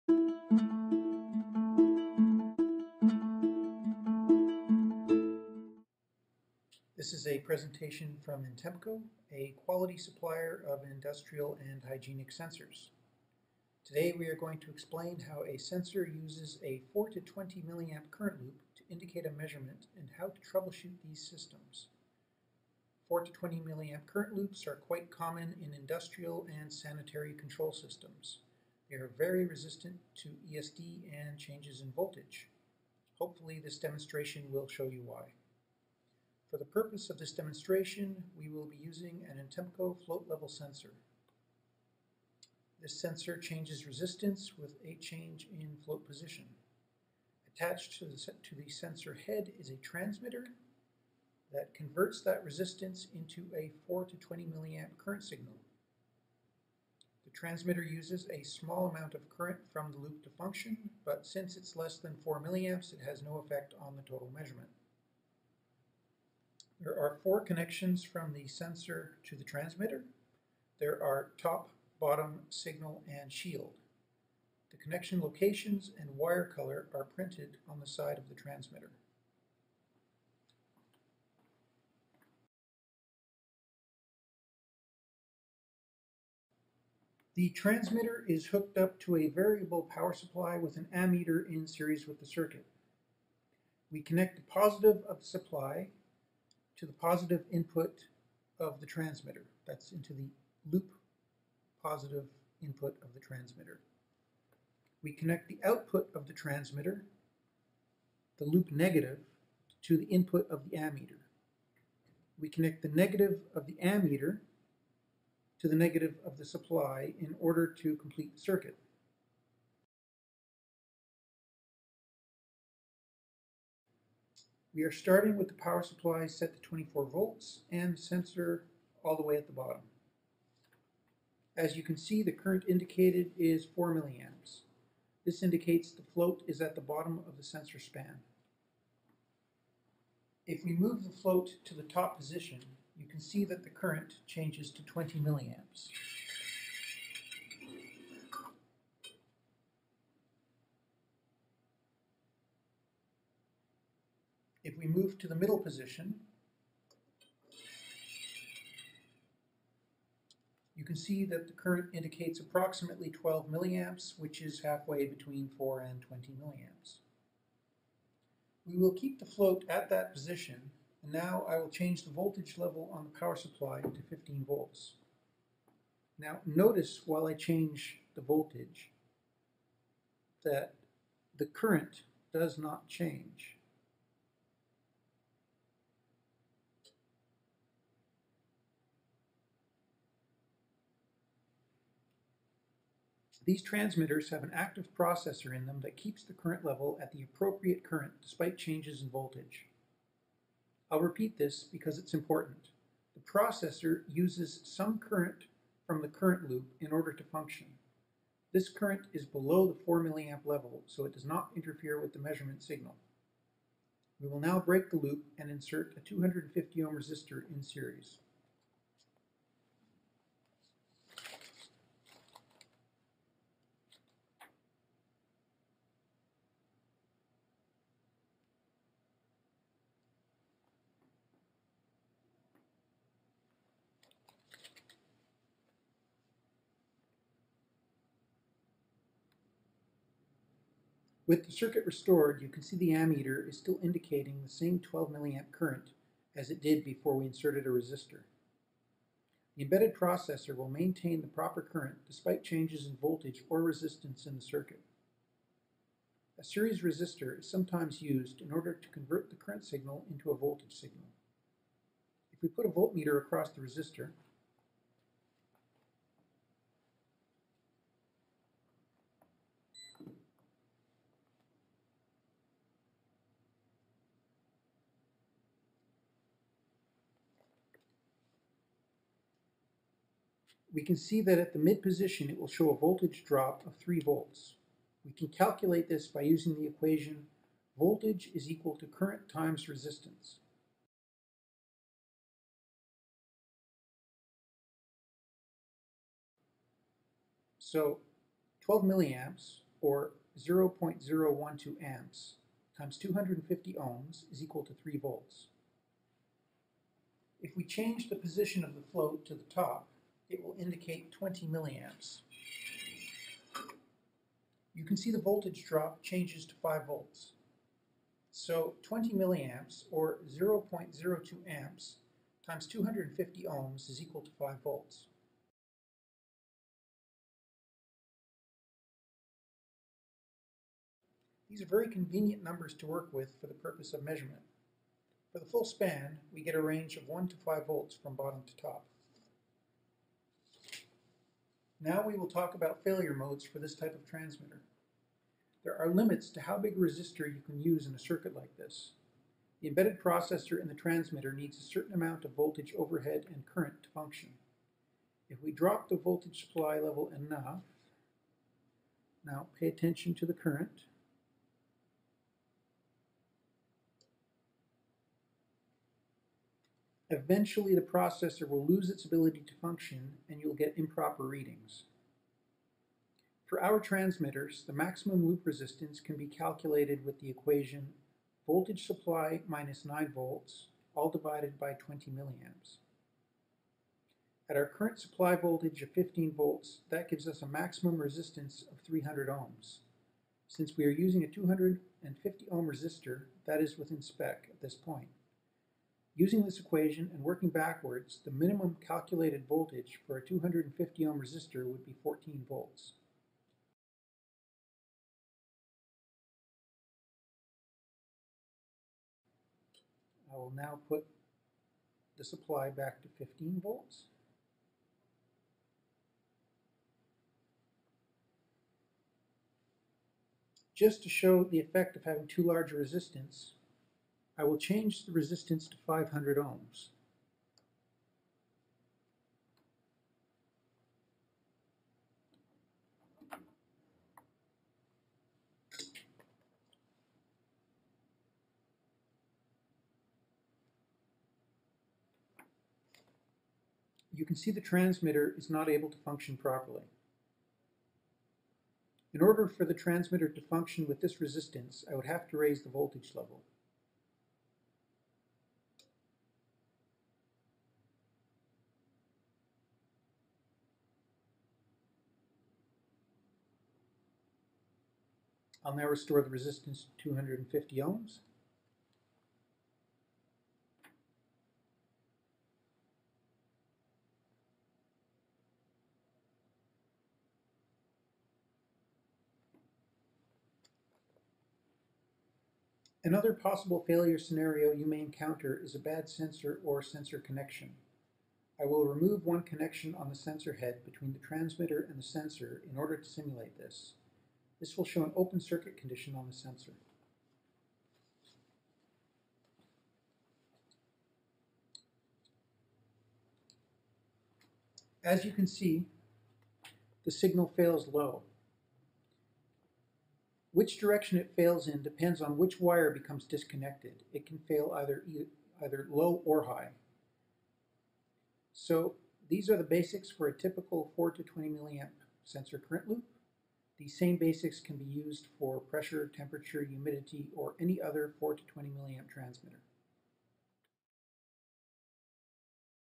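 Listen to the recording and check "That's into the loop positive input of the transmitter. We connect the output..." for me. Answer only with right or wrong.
right.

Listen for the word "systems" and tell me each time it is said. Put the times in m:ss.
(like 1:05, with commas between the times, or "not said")
0:21, 0:27.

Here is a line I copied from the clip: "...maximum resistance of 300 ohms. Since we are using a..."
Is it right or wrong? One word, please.
right.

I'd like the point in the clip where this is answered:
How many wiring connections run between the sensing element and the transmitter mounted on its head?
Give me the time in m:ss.
1:07.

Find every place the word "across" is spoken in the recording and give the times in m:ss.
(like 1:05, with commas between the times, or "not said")
4:23.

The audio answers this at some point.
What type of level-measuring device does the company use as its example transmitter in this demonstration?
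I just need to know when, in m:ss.
0:40.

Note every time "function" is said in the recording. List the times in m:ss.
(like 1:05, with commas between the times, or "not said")
1:00, 3:27, 5:53, 6:09, 7:25, 7:30.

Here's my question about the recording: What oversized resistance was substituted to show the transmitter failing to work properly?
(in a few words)
500 ohms.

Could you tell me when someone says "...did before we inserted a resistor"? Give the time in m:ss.
4:06.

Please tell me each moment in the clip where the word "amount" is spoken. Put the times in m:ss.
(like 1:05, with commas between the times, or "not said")
0:58, 5:51.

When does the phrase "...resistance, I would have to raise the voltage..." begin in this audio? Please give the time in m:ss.
7:31.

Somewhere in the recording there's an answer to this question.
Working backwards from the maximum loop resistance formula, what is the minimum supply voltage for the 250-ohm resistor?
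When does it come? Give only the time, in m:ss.
6:42.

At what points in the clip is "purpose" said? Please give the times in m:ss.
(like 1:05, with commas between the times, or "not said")
0:36, 5:33.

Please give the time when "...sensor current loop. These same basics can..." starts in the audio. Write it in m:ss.
8:42.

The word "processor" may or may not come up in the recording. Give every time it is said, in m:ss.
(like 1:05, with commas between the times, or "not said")
3:14, 3:23, 4:09, 5:49, 6:07.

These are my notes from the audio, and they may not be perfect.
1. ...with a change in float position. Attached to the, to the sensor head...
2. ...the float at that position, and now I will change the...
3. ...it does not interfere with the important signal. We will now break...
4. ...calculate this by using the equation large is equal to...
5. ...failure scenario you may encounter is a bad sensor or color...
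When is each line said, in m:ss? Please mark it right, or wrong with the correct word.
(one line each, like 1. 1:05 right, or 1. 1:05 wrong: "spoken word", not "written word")
1. 0:44 right
2. 2:49 right
3. 3:31 wrong: "measurement", not "important"
4. 4:45 wrong: "voltage", not "large"
5. 8:03 wrong: "sensor", not "color".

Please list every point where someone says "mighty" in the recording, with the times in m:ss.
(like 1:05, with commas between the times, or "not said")
not said.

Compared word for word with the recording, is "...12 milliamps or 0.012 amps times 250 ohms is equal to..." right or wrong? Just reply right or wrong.
right.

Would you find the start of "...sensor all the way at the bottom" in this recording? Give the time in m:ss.
2:08.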